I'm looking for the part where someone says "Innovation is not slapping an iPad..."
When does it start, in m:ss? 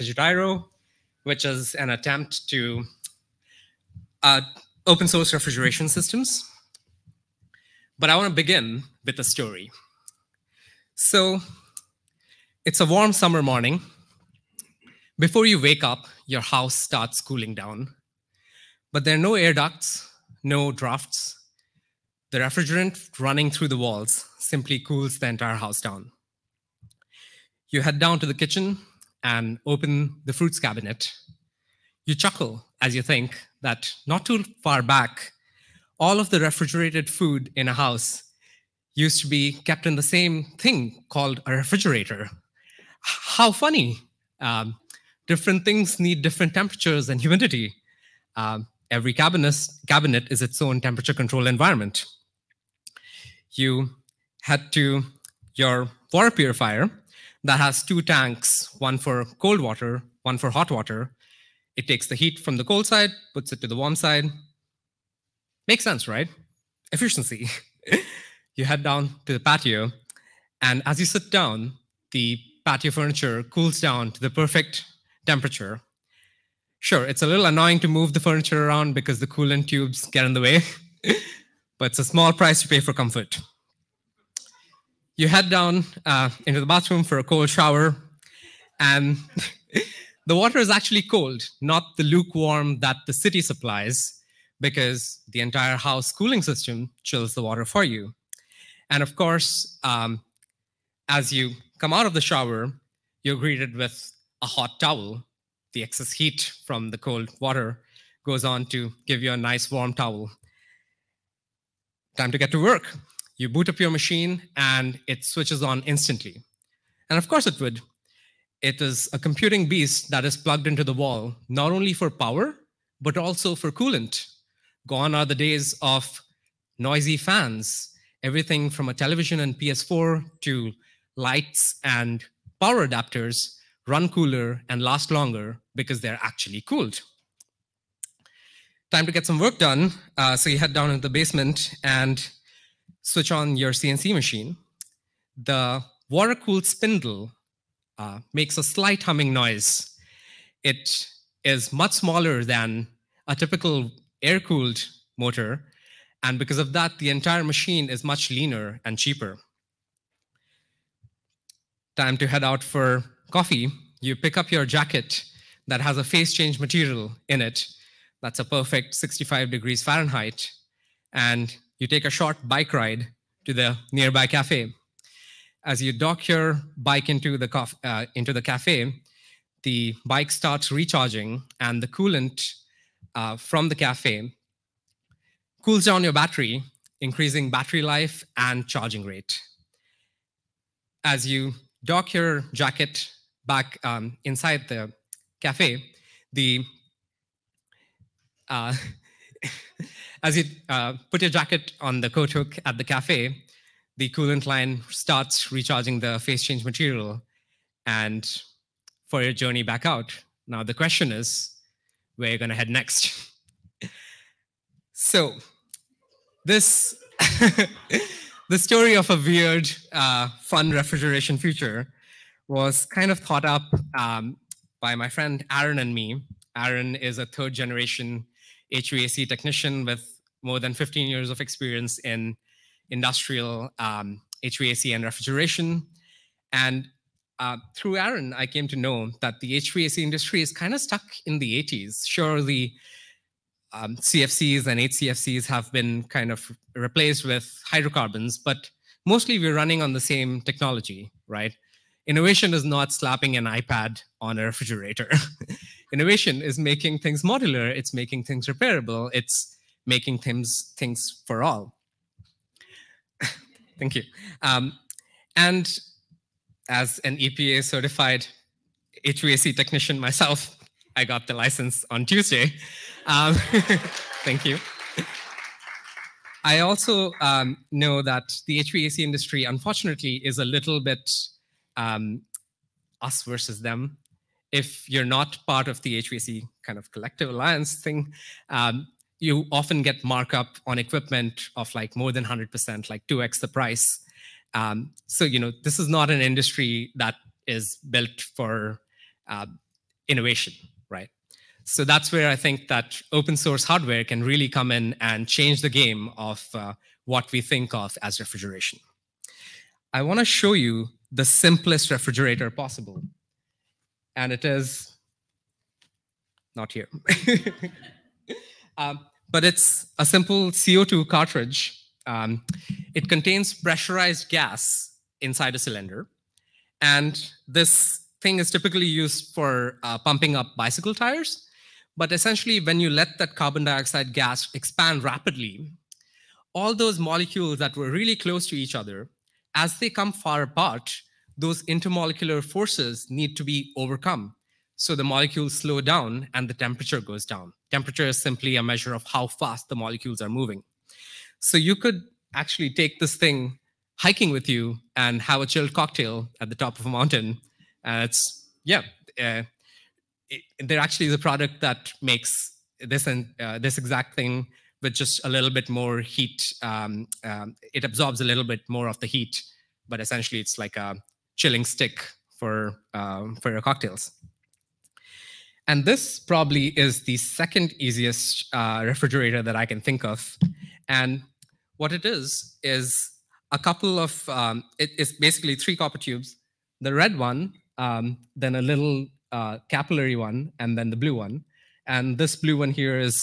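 4:12.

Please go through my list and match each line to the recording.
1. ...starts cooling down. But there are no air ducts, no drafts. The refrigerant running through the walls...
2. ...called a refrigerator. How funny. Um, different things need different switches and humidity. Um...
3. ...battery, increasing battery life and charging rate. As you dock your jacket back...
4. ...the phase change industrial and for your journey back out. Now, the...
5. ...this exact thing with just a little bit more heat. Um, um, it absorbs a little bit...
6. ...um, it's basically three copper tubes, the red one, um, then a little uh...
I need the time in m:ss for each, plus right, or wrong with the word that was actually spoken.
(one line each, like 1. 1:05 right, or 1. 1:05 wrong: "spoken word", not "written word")
1. 0:16 right
2. 0:41 wrong: "temperatures", not "switches"
3. 3:06 right
4. 3:25 wrong: "material", not "industrial"
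5. 6:03 right
6. 6:24 right.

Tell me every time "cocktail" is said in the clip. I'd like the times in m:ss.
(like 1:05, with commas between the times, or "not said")
5:55, 6:13.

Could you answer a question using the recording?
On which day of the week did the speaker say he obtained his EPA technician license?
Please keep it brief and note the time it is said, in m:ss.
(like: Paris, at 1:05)
Tuesday, at 4:32.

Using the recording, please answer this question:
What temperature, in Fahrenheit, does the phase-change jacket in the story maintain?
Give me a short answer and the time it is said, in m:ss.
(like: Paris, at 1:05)
65 degrees Fahrenheit, at 2:48.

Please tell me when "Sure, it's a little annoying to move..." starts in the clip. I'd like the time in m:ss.
1:16.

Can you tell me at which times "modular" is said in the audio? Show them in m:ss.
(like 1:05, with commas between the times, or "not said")
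4:17.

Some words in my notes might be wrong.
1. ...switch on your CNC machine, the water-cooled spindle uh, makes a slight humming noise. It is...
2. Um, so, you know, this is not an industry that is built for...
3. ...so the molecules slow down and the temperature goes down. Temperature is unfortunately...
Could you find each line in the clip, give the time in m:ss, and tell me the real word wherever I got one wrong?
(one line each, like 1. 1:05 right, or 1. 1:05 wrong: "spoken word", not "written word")
1. 2:23 right
2. 4:54 right
3. 5:44 wrong: "simply", not "unfortunately".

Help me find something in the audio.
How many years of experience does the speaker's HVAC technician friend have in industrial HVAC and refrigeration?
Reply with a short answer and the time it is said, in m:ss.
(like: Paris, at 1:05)
more than 15 years, at 3:50.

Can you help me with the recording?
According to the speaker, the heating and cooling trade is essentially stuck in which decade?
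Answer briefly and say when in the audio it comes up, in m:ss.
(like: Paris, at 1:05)
the 80s, at 4:01.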